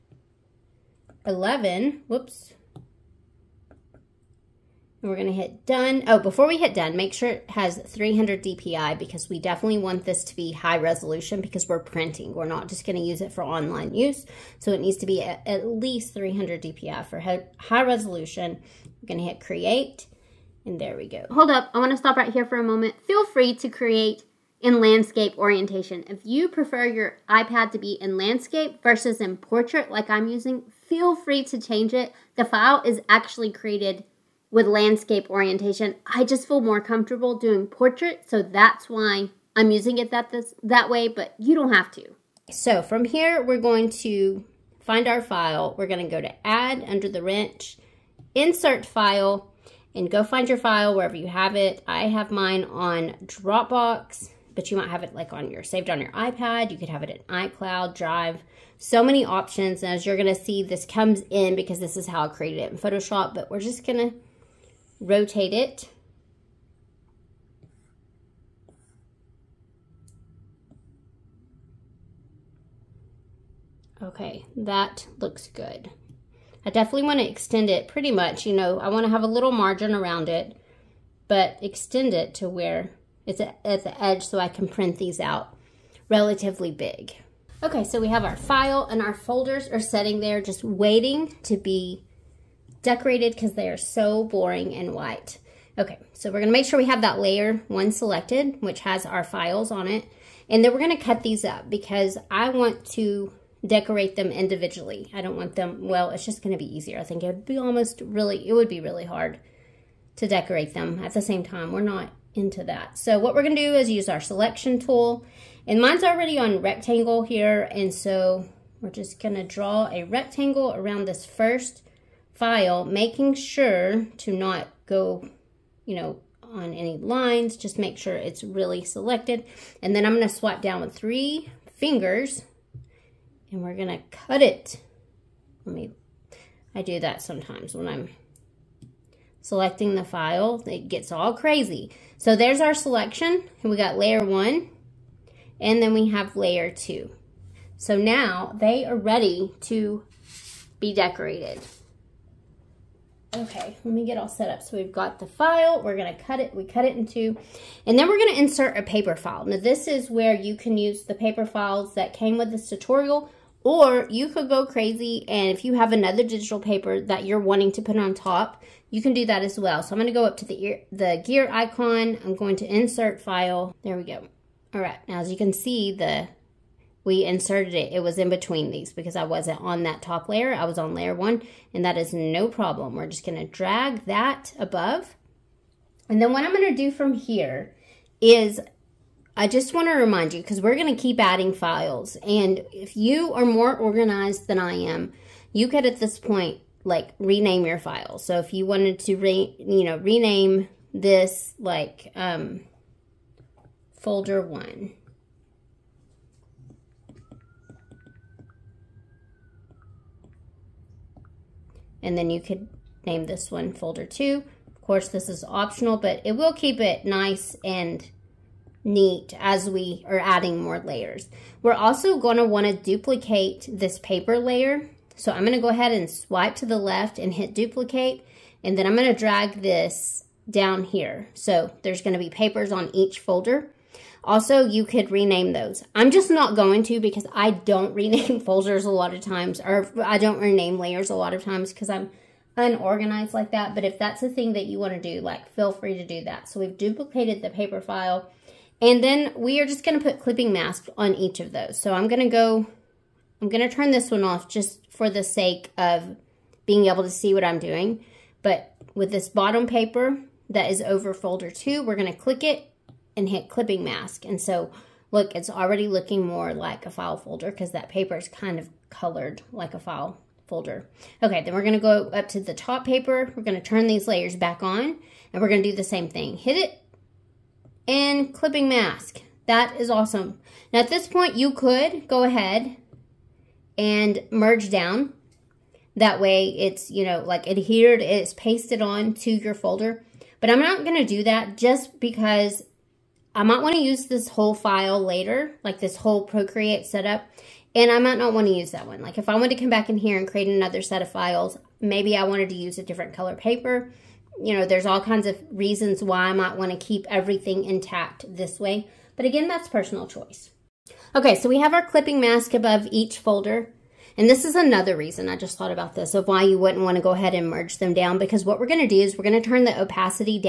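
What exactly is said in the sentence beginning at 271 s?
Okay, then we're gonna go up to the top paper.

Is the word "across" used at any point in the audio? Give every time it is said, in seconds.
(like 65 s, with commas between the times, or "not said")
not said.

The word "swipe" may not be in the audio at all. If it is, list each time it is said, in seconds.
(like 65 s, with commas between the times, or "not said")
130 s, 226 s.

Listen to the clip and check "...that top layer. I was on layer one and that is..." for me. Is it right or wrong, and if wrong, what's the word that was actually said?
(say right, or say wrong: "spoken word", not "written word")
right.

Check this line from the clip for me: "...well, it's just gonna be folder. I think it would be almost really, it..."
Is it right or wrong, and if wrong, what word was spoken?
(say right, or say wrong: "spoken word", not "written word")
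wrong: "easier", not "folder".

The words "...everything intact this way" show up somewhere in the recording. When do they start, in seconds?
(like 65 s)
307 s.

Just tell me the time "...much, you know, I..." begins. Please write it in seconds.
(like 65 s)
78 s.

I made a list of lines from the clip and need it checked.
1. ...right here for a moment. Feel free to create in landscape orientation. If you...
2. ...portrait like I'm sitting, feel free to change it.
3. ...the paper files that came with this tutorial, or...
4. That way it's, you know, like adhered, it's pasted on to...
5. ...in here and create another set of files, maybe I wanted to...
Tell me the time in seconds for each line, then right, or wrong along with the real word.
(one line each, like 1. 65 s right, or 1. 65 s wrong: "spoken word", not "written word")
1. 22 s right
2. 29 s wrong: "using", not "sitting"
3. 161 s right
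4. 285 s right
5. 299 s right.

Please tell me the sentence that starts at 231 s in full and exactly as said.
So there's going to be papers on each folder.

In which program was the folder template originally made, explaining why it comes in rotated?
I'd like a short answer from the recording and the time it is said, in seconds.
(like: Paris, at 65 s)
Photoshop, at 62 s.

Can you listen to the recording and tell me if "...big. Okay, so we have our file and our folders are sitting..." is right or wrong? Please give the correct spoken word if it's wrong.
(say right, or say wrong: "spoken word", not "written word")
right.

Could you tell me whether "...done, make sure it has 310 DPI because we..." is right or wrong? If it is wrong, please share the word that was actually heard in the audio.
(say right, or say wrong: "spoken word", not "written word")
wrong: "300", not "310".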